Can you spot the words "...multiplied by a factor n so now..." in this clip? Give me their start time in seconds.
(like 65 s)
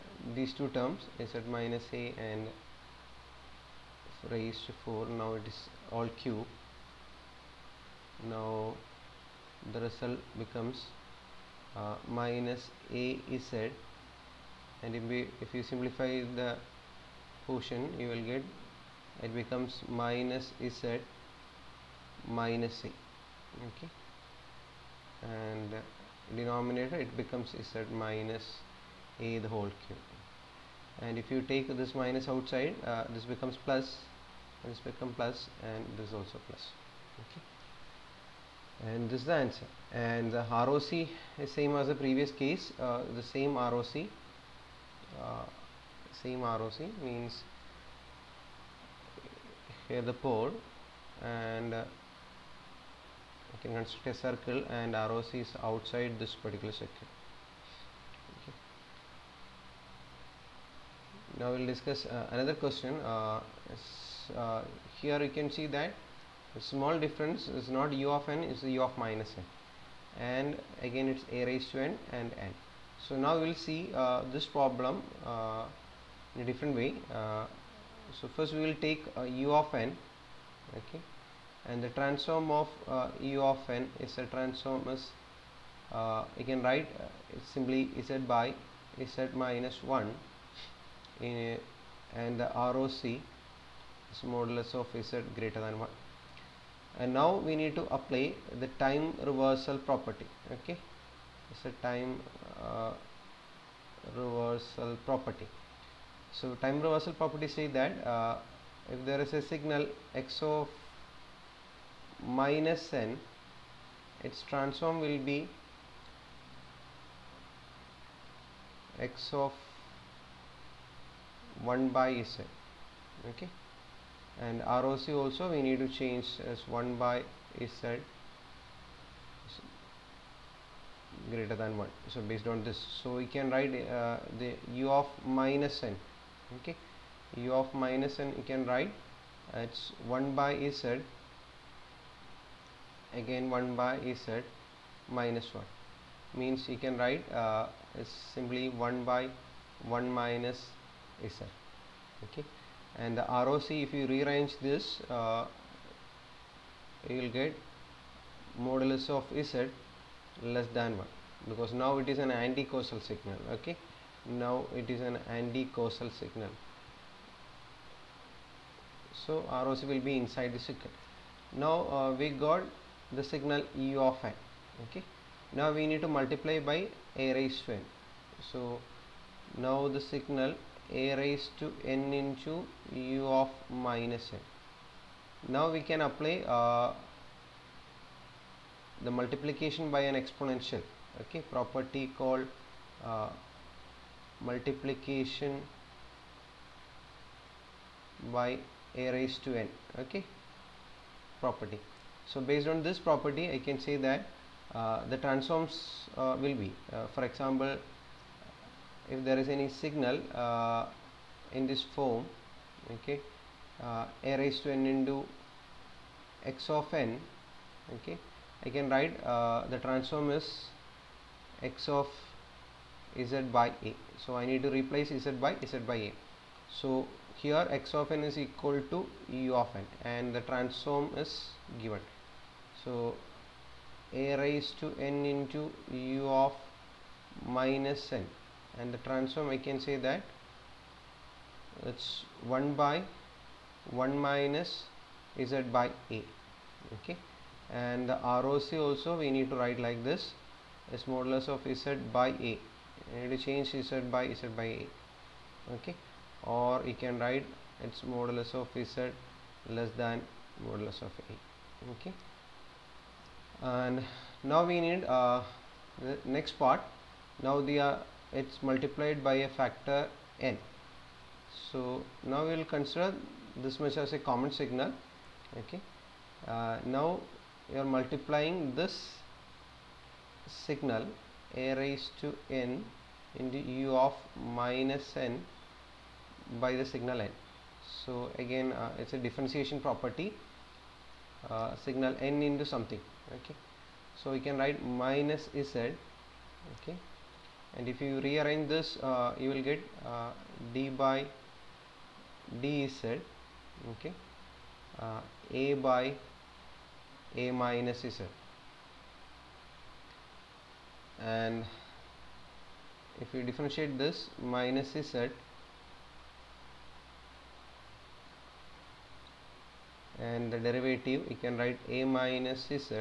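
268 s.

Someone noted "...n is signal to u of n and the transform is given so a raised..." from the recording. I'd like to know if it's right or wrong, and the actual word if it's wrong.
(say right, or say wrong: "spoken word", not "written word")
wrong: "equal", not "signal".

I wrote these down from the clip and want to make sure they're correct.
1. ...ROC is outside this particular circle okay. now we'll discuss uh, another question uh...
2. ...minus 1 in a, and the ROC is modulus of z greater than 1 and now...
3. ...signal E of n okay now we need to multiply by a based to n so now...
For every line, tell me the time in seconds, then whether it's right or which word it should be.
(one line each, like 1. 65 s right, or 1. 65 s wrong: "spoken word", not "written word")
1. 54 s right
2. 89 s right
3. 173 s wrong: "raised", not "based".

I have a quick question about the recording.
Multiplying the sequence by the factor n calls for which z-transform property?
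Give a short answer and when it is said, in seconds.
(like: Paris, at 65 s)
differentiation property, at 289 s.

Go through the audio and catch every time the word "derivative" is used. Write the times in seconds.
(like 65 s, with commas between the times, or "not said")
320 s.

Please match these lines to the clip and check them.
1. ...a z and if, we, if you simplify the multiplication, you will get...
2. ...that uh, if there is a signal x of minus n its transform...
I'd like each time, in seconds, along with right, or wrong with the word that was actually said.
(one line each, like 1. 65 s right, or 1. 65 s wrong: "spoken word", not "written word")
1. 12 s wrong: "portion", not "multiplication"
2. 107 s right.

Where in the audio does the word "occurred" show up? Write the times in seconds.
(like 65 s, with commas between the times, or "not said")
not said.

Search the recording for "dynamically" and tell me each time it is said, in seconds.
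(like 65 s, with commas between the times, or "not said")
not said.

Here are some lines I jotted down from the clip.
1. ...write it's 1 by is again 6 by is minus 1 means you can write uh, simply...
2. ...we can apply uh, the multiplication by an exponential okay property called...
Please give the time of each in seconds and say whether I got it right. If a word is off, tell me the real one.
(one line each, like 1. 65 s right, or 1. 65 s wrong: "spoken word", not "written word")
1. 138 s wrong: "1", not "6"
2. 185 s right.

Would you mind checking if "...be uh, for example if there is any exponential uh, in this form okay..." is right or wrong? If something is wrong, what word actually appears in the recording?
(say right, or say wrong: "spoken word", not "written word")
wrong: "signal", not "exponential".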